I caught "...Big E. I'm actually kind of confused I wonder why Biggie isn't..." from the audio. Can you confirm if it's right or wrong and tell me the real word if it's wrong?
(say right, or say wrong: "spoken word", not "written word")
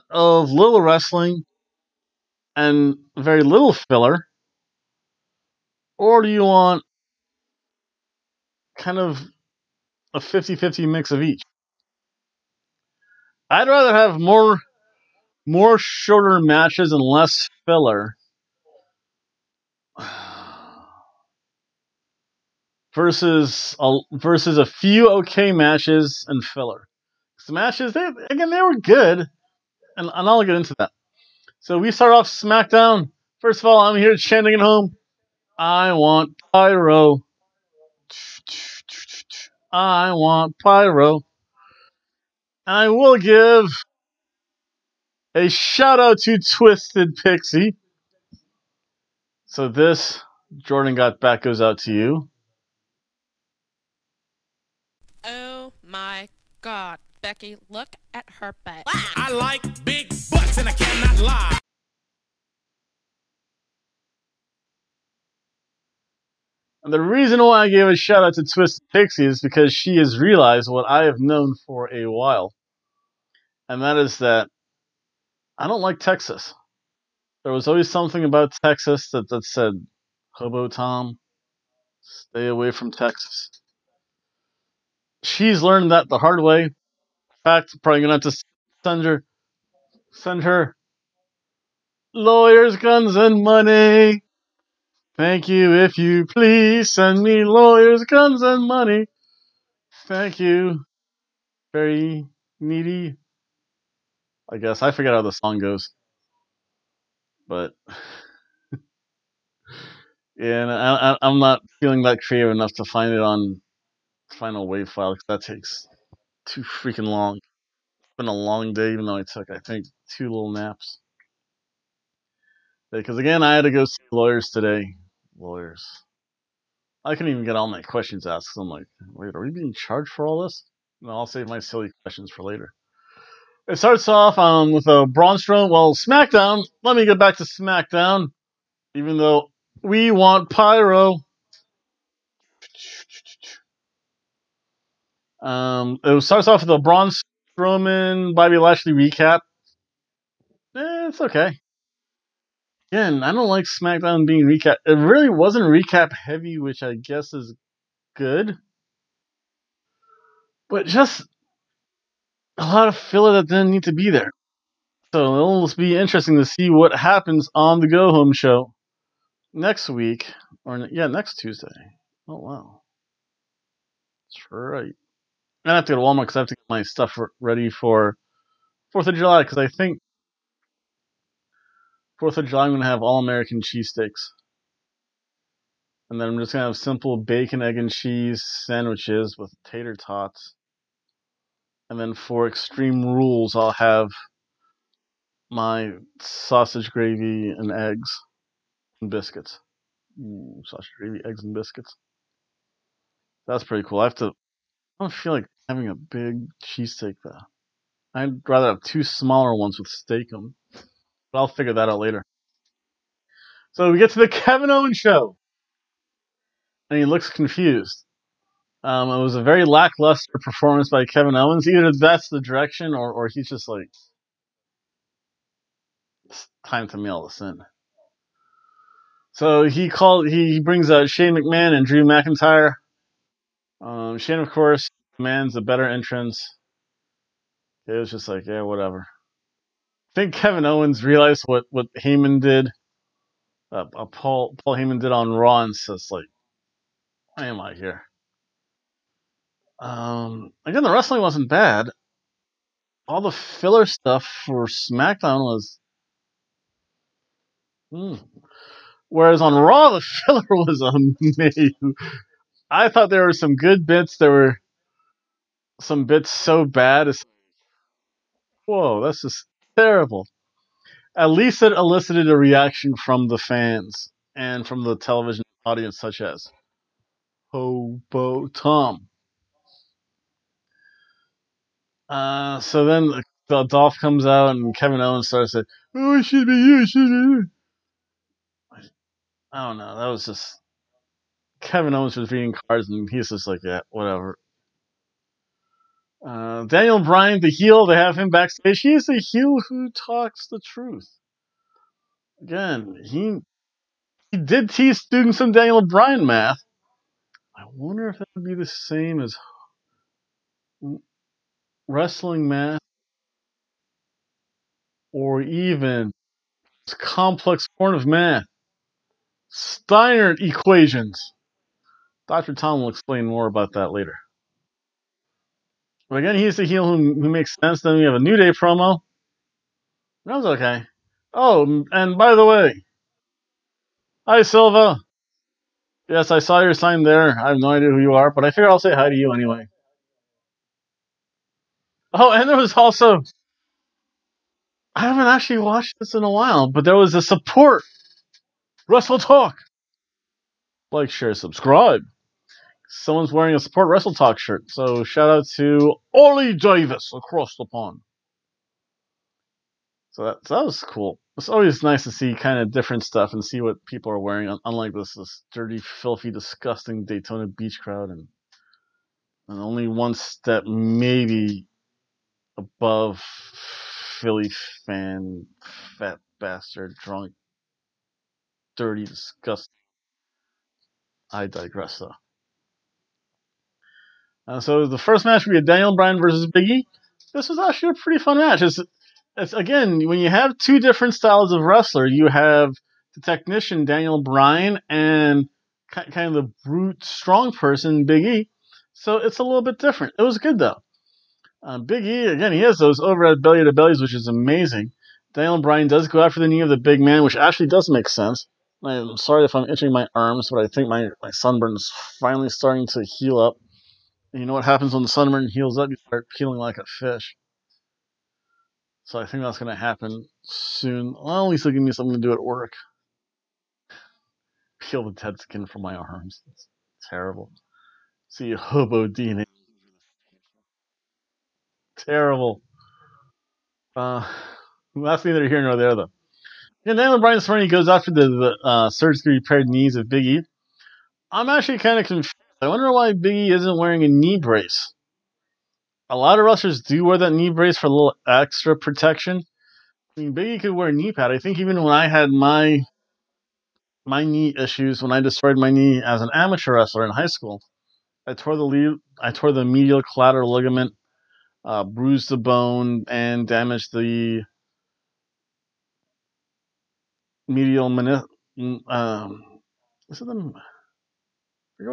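right.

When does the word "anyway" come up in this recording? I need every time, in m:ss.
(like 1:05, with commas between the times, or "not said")
5:39.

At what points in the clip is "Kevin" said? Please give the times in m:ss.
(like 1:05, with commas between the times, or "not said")
3:34, 3:41, 4:00, 4:44, 4:51.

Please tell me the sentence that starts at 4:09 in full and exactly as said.
Um, again, the wrestling wasn't bad.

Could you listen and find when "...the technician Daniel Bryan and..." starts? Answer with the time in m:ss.
6:33.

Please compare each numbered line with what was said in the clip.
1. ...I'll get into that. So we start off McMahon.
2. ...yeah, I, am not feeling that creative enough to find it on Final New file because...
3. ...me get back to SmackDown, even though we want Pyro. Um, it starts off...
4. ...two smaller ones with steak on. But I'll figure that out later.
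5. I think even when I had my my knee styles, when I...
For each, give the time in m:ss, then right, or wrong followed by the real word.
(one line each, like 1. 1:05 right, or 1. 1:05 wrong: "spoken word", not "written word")
1. 0:30 wrong: "SmackDown", not "McMahon"
2. 1:50 wrong: "Wave", not "New"
3. 2:16 right
4. 3:28 right
5. 7:31 wrong: "issues", not "styles".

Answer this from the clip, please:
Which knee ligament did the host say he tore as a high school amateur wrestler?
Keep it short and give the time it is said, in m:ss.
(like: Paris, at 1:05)
Medial collateral ligament, at 7:39.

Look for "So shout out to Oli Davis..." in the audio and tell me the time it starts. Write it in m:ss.
5:54.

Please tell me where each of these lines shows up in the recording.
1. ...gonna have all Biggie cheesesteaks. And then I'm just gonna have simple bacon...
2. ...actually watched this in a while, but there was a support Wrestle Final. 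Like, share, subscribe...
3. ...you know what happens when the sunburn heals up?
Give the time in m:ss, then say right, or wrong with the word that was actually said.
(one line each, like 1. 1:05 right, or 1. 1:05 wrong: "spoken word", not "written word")
1. 3:02 wrong: "American", not "Biggie"
2. 5:45 wrong: "Talk", not "Final"
3. 6:54 right.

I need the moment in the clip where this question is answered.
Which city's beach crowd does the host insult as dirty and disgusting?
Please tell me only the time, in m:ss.
6:07.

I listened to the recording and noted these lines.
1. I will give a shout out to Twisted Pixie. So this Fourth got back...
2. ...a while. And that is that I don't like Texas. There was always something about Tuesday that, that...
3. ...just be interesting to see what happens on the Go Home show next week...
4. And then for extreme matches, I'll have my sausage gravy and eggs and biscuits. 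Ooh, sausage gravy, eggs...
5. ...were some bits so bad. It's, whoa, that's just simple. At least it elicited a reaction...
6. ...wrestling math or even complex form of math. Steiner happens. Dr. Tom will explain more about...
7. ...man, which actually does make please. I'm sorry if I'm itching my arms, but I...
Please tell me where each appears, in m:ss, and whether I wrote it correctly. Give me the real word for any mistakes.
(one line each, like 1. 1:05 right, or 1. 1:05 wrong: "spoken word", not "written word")
1. 0:42 wrong: "Jordan", not "Fourth"
2. 1:11 wrong: "Texas", not "Tuesday"
3. 2:45 right
4. 3:11 wrong: "rules", not "matches"
5. 4:24 wrong: "terrible", not "simple"
6. 5:11 wrong: "equations", not "happens"
7. 6:47 wrong: "sense", not "please".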